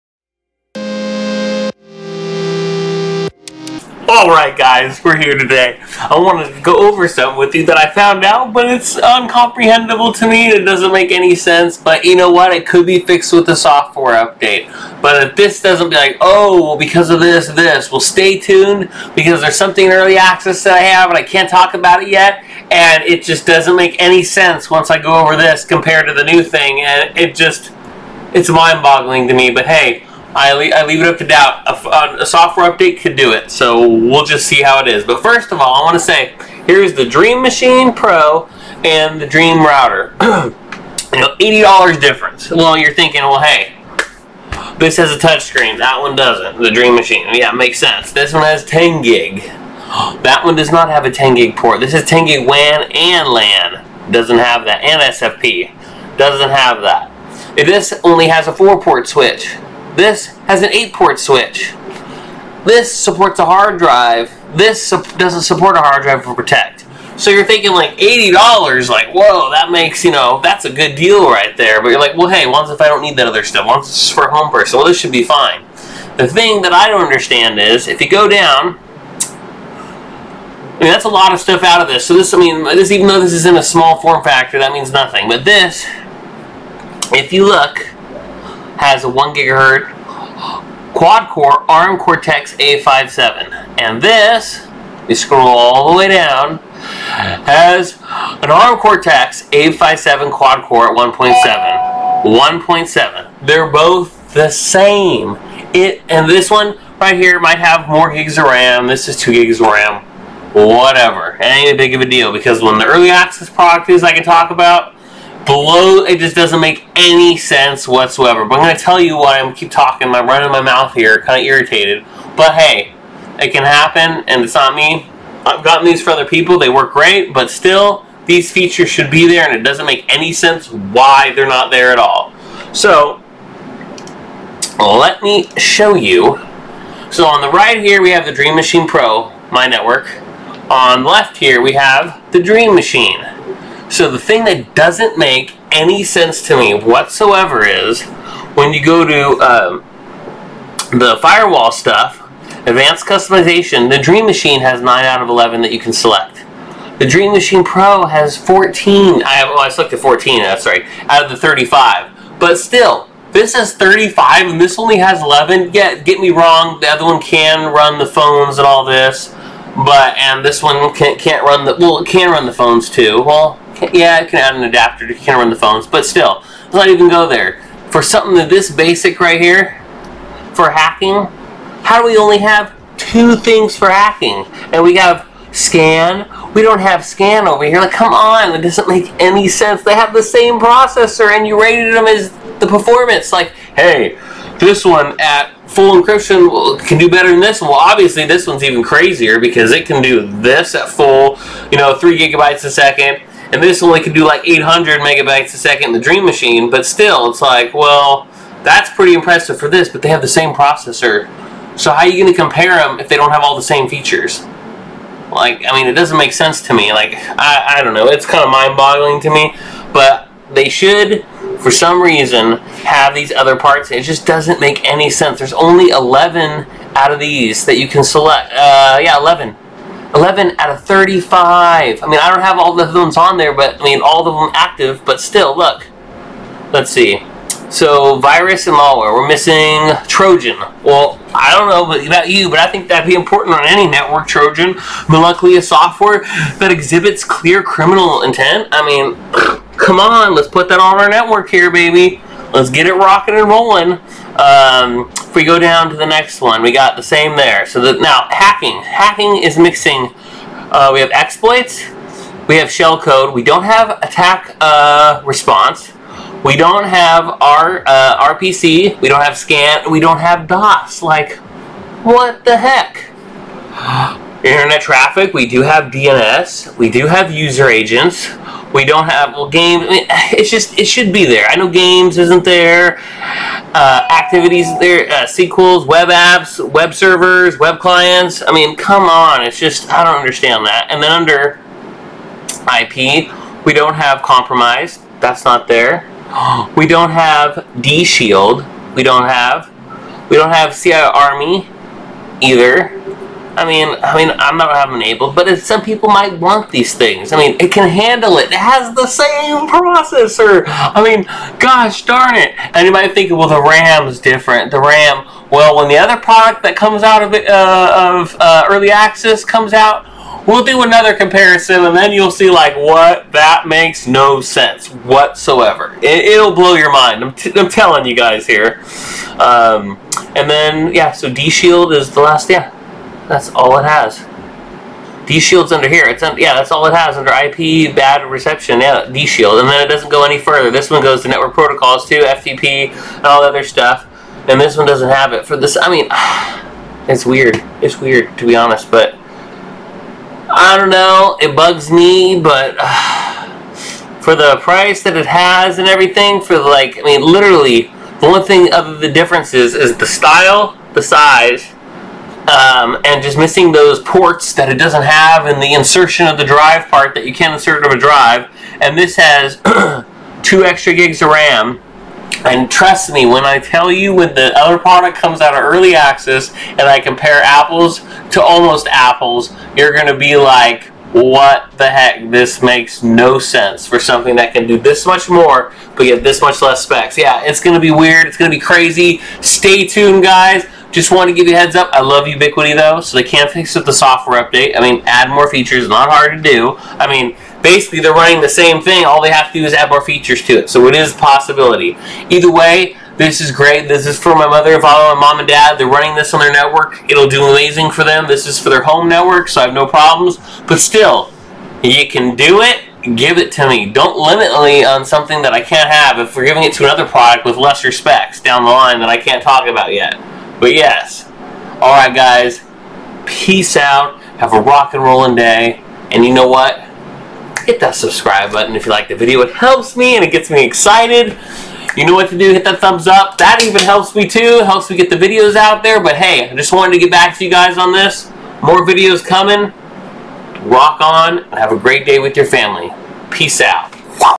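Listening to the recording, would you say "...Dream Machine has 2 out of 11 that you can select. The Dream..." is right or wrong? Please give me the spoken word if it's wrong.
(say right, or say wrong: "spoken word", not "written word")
wrong: "9", not "2".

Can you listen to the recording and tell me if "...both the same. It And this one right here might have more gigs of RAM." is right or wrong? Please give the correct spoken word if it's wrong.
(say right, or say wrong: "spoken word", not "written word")
right.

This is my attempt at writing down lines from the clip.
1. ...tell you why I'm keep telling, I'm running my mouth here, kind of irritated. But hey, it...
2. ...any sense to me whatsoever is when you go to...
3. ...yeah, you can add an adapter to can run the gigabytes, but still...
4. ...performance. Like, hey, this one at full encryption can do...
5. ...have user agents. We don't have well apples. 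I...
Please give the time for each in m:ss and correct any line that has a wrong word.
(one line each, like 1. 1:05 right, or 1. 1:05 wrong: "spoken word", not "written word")
1. 1:58 wrong: "talking", not "telling"
2. 2:25 right
3. 2:53 wrong: "phones", not "gigabytes"
4. 3:12 right
5. 4:37 wrong: "games", not "apples".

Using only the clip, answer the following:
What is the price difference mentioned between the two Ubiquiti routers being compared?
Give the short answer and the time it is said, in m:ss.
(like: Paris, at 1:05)
$80, at 0:41.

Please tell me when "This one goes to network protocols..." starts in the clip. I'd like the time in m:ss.
5:40.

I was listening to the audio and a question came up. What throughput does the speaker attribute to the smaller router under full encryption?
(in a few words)
800 megabytes a second.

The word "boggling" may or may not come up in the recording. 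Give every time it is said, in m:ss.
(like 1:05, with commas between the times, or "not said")
0:28, 3:38.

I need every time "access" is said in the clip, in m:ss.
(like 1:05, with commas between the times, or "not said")
0:20, 1:53, 5:18, 6:15.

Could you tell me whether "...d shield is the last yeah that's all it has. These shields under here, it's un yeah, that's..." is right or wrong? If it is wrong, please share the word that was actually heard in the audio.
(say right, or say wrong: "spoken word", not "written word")
right.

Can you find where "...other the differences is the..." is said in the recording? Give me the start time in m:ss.
5:58.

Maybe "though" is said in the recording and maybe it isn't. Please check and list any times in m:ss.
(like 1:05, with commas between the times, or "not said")
1:23, 6:32.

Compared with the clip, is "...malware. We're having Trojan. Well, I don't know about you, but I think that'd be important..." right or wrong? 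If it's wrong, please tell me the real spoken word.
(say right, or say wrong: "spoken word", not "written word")
wrong: "missing", not "having".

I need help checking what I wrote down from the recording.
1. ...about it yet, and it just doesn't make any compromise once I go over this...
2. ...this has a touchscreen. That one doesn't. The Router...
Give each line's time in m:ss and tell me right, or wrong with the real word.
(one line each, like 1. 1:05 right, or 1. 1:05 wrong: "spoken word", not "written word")
1. 0:21 wrong: "sense", not "compromise"
2. 0:44 wrong: "Dream", not "Router".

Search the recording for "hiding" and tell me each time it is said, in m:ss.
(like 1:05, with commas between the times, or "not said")
not said.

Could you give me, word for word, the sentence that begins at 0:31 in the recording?
A, uh, a, software update could do it, so we'll just see how it is.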